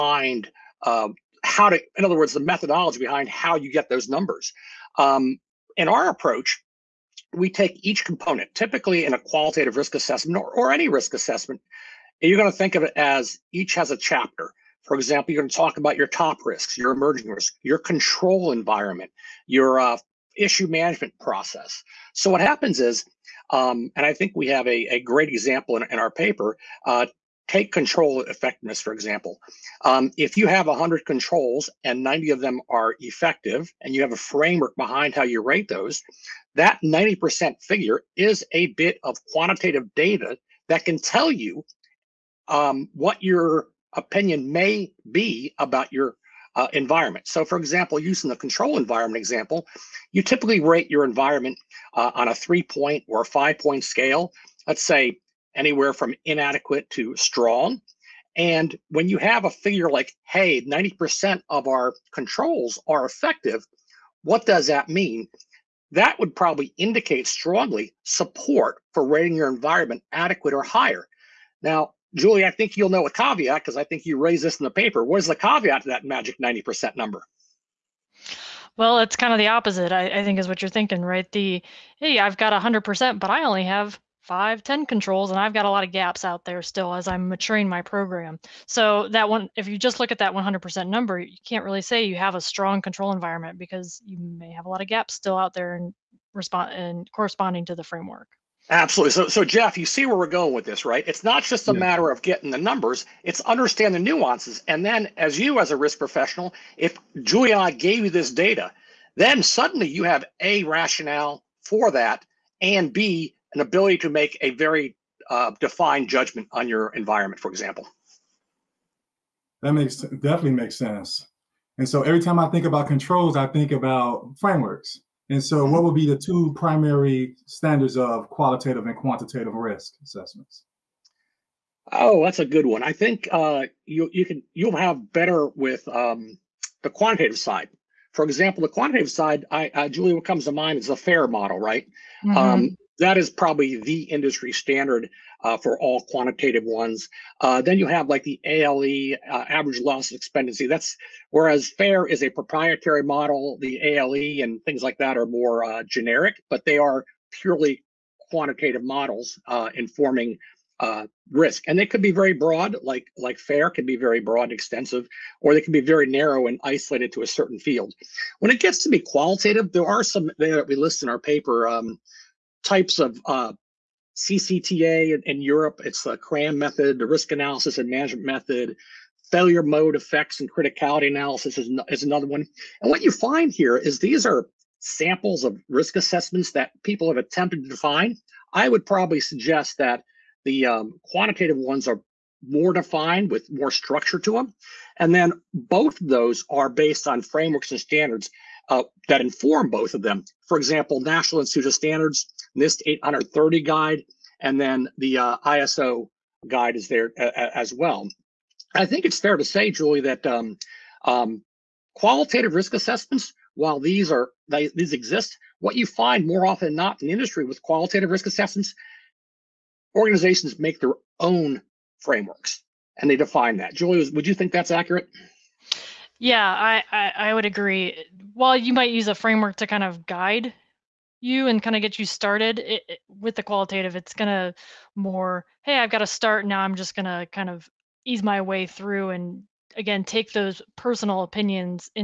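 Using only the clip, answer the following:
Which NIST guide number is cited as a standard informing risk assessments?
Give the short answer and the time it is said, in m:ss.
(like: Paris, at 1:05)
830, at 3:22.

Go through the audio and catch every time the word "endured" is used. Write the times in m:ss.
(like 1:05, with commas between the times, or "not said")
not said.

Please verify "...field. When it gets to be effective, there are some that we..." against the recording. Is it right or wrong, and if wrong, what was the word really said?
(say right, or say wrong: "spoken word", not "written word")
wrong: "qualitative", not "effective".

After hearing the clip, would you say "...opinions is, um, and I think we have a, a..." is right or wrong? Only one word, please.
wrong.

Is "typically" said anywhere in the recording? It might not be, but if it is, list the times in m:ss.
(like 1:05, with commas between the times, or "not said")
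0:08, 0:50.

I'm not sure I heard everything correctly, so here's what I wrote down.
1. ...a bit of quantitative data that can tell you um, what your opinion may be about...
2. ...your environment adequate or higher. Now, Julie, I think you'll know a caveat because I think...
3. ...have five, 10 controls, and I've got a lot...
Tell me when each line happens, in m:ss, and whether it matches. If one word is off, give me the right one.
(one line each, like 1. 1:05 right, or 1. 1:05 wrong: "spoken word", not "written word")
1. 0:38 right
2. 1:09 right
3. 1:23 right.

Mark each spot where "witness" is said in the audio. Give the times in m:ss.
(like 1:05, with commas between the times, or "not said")
not said.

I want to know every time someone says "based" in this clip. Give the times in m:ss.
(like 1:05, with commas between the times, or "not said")
3:16.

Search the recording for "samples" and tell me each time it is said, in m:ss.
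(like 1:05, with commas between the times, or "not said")
3:04.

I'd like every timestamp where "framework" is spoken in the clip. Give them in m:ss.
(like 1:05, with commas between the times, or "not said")
0:34, 1:37, 2:04, 3:17, 3:41, 3:49.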